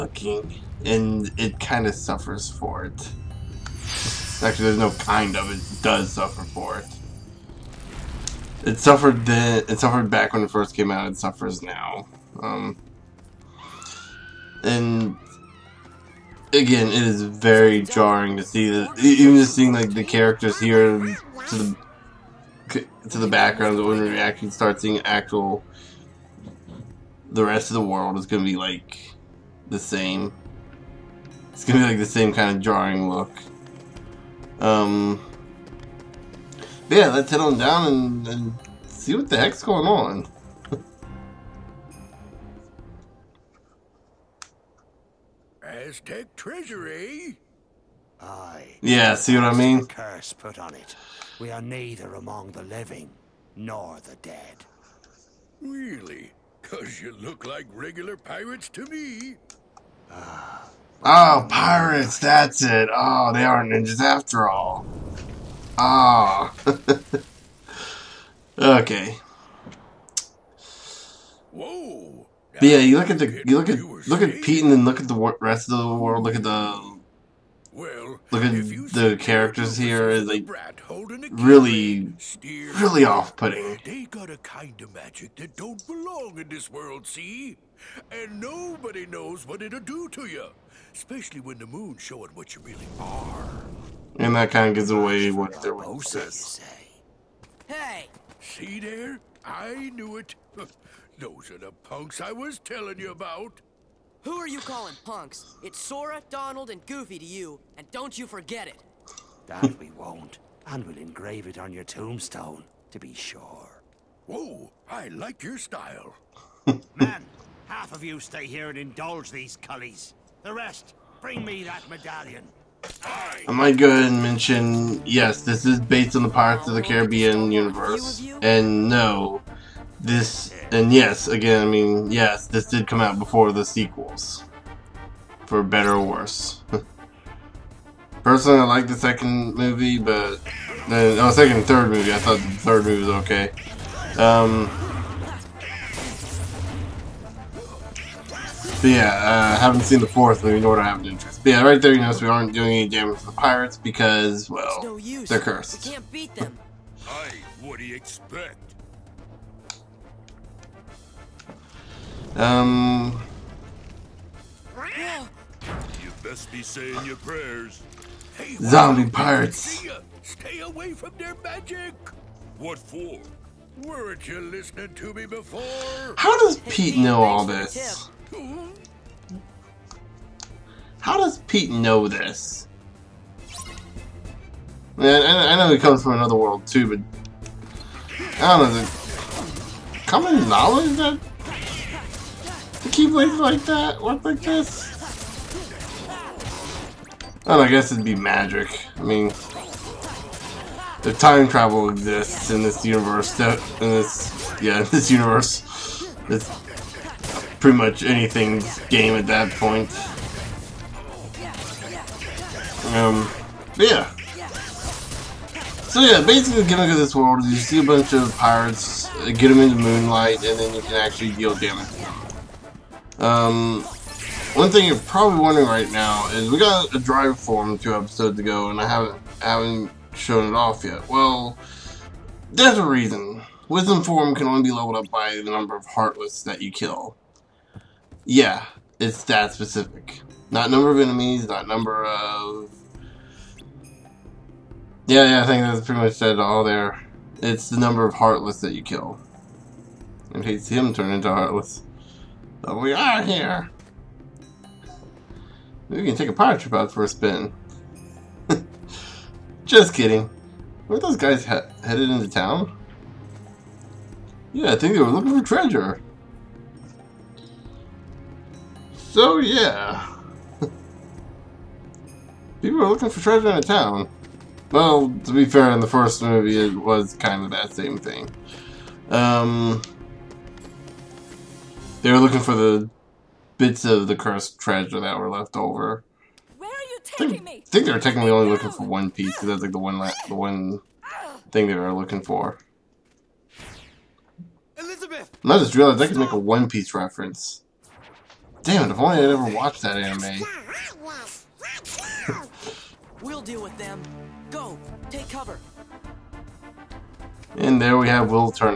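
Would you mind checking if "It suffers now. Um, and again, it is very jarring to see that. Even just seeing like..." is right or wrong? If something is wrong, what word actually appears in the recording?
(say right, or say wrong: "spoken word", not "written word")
right.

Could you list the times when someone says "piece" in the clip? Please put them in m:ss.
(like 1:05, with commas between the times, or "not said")
4:49, 4:56.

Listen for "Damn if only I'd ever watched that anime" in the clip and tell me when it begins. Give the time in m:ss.
4:58.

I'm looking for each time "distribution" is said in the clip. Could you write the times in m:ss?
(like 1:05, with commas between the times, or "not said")
not said.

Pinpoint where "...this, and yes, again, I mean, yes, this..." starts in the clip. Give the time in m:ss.
2:10.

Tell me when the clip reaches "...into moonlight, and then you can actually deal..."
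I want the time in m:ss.
3:39.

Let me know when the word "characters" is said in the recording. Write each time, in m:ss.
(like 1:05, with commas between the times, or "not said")
0:20, 1:19.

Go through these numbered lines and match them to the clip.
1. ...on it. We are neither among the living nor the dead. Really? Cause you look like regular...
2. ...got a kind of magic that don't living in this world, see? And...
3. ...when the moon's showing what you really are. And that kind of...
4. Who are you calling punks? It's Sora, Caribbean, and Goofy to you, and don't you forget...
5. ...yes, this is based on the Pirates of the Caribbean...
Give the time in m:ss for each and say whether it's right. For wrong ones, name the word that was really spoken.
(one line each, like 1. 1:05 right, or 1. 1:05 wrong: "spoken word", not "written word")
1. 0:50 right
2. 1:24 wrong: "belong", not "living"
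3. 1:31 right
4. 1:44 wrong: "Donald", not "Caribbean"
5. 2:05 right.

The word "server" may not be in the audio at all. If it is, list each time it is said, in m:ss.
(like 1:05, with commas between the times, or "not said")
not said.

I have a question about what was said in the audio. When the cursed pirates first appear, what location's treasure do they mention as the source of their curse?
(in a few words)
Aztec treasury.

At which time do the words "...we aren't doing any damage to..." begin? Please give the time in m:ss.
2:32.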